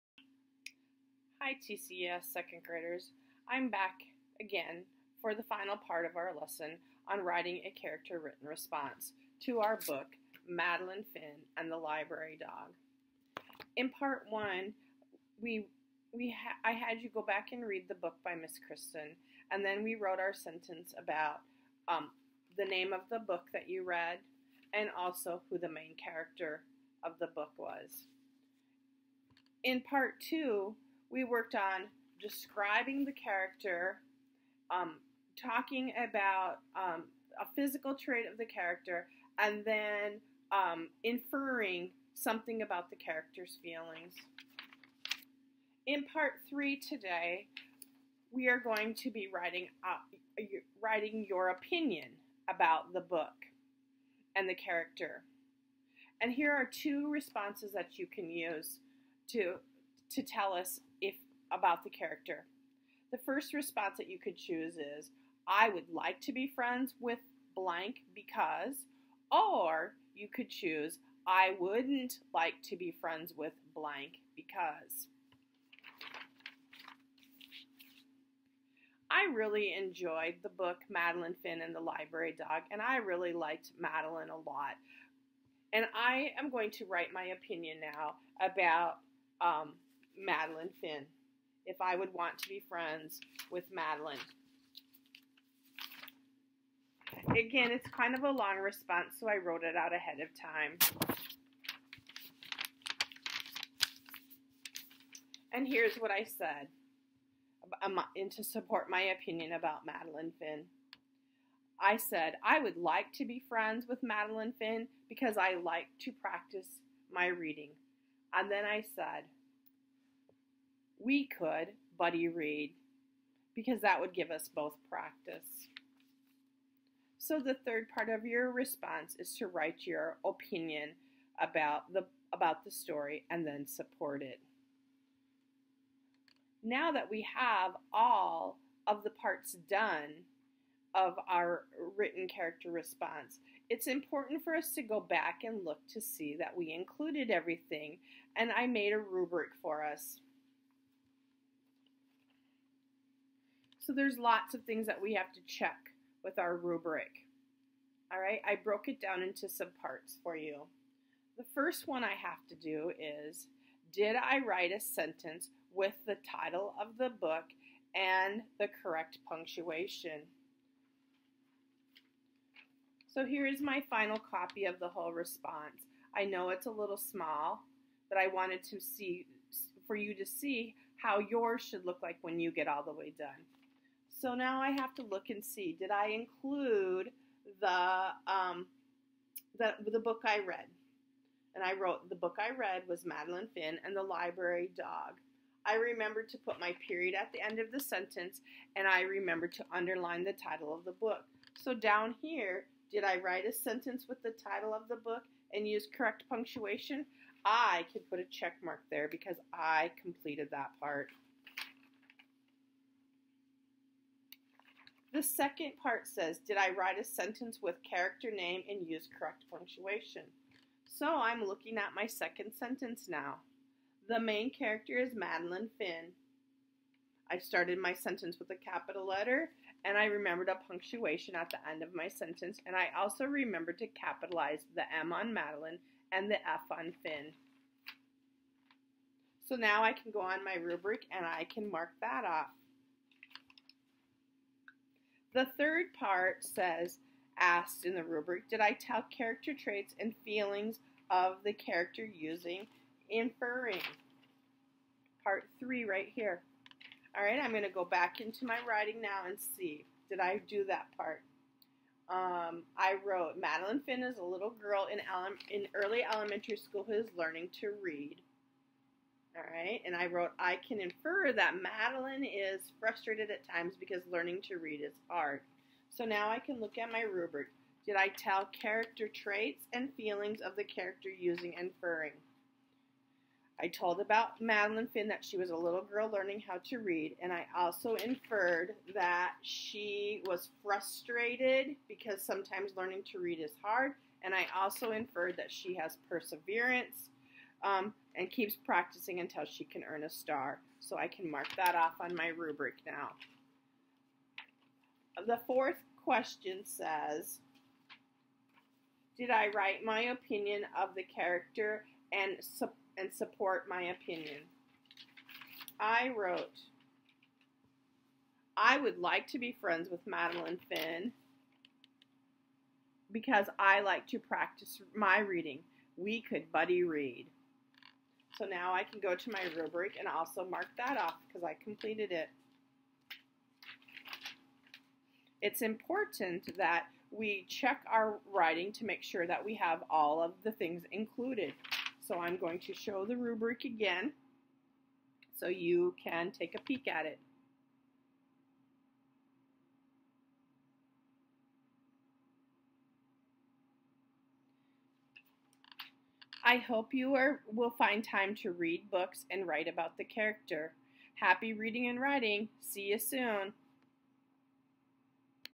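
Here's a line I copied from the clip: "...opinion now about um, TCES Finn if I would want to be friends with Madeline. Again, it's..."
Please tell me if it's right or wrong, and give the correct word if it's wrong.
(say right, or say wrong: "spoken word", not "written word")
wrong: "Madeline", not "TCES".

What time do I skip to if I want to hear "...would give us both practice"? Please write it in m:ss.
2:03.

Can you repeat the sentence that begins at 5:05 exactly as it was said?
The fourth question says, did I write my opinion of the character and, su and support my opinion?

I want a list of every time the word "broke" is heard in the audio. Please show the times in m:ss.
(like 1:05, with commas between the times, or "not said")
2:38.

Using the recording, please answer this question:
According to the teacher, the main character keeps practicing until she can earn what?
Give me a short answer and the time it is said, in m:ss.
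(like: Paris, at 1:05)
a star, at 5:00.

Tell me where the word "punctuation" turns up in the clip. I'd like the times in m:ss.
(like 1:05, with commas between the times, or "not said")
2:49, 3:26, 3:39, 3:50.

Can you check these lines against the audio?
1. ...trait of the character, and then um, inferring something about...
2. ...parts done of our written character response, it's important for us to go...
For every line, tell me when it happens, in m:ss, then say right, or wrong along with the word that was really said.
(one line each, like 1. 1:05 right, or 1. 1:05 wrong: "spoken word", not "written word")
1. 0:37 right
2. 2:19 right.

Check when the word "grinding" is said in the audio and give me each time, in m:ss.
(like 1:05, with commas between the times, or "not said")
not said.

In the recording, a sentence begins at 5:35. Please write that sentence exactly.
It's important that we check our writing to make sure that we have all of the things included.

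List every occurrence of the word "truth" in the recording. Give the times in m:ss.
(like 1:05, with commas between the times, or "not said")
not said.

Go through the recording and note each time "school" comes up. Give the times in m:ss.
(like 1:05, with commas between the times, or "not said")
4:26.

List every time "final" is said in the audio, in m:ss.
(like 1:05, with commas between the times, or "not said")
0:05, 2:53.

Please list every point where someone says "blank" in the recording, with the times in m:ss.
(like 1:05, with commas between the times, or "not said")
1:07, 1:13.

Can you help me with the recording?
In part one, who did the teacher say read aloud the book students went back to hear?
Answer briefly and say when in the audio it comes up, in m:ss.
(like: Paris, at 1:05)
Miss Kristen, at 0:18.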